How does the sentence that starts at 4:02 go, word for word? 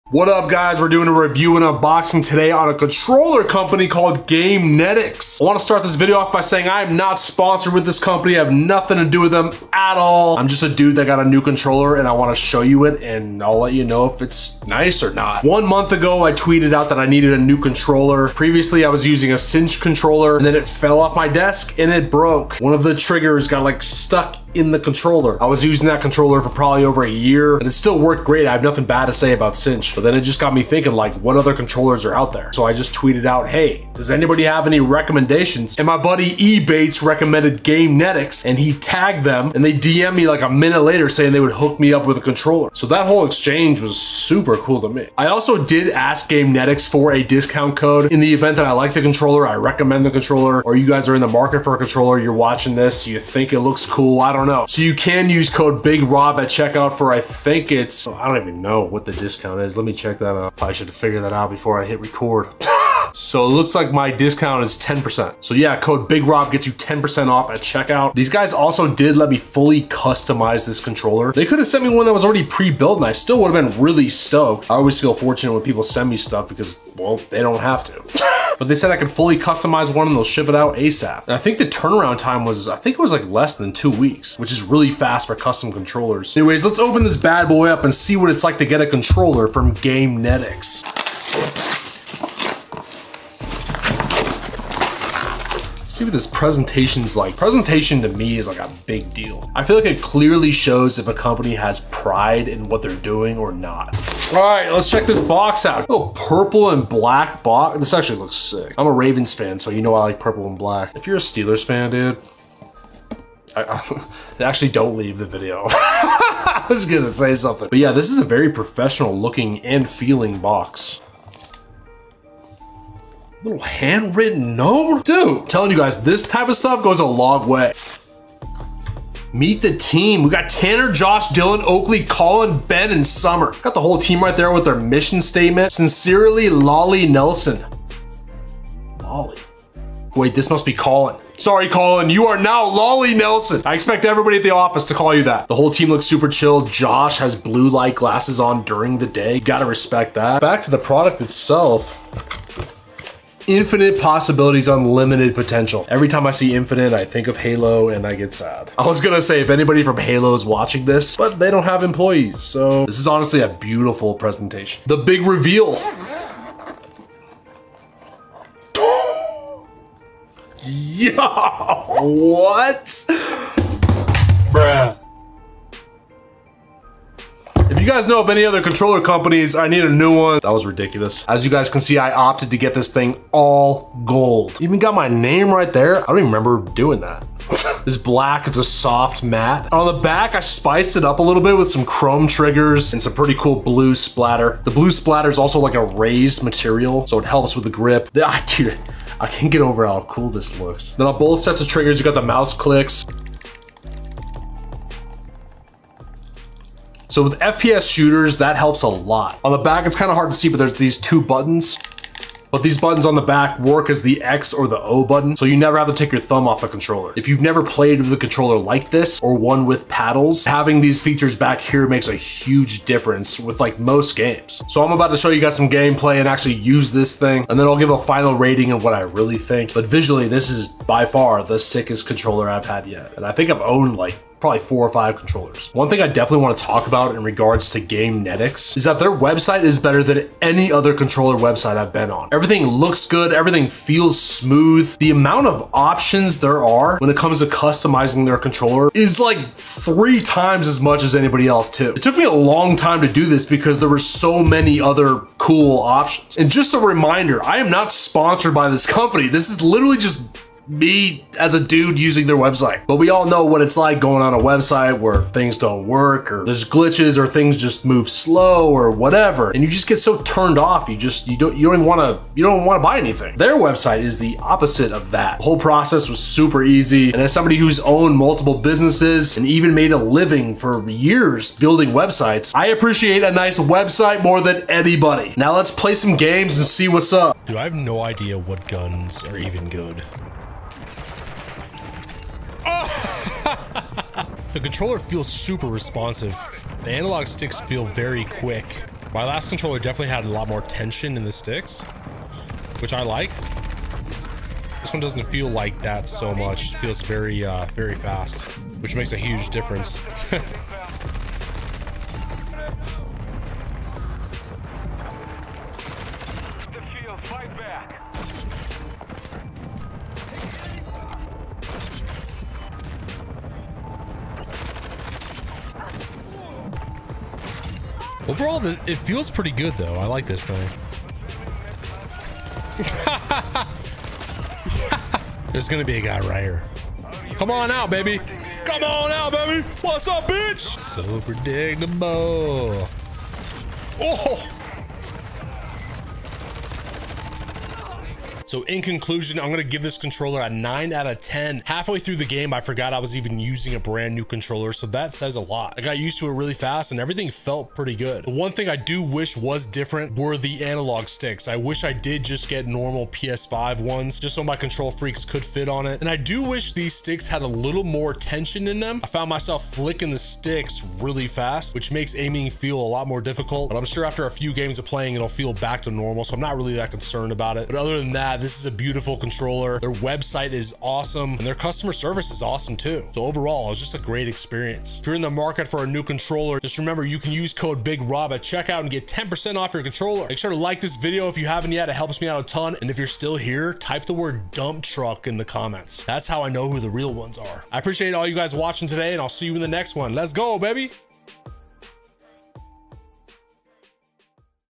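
Everything looks good, everything feels smooth.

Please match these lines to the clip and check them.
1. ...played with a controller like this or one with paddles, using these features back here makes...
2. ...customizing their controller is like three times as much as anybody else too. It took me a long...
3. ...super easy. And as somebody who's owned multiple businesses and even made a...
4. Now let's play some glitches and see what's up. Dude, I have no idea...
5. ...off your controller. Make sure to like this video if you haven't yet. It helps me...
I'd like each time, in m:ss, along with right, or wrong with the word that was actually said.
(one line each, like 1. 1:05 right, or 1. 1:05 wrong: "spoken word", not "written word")
1. 3:37 wrong: "having", not "using"
2. 4:07 right
3. 4:36 right
4. 4:45 wrong: "games", not "glitches"
5. 6:29 right.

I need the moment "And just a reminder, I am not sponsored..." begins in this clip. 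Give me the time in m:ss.
4:16.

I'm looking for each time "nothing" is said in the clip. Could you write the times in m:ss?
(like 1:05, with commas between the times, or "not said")
0:08, 0:28.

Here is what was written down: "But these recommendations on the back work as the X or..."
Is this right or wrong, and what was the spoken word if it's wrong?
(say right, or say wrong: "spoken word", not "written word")
wrong: "buttons", not "recommendations".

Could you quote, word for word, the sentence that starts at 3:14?
The blue splatter is also like a raised material, so it helps with the grip.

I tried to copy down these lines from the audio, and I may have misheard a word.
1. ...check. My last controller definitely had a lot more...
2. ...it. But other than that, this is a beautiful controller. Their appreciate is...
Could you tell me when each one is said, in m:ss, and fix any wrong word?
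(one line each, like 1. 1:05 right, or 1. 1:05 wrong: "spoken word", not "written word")
1. 4:58 wrong: "quick", not "check"
2. 6:17 wrong: "website", not "appreciate".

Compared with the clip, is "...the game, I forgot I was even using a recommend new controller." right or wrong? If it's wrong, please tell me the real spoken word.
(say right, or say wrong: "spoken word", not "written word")
wrong: "brand", not "recommend".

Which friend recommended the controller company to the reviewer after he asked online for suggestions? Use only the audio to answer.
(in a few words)
E Bates.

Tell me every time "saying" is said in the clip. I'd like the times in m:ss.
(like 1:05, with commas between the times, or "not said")
0:06, 0:41.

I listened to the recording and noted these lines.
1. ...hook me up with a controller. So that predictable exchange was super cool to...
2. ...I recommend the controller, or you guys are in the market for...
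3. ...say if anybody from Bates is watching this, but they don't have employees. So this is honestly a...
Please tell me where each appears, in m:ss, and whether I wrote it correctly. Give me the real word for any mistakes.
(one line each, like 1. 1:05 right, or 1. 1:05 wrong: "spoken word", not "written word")
1. 0:41 wrong: "whole", not "predictable"
2. 0:49 right
3. 2:39 wrong: "Halo", not "Bates".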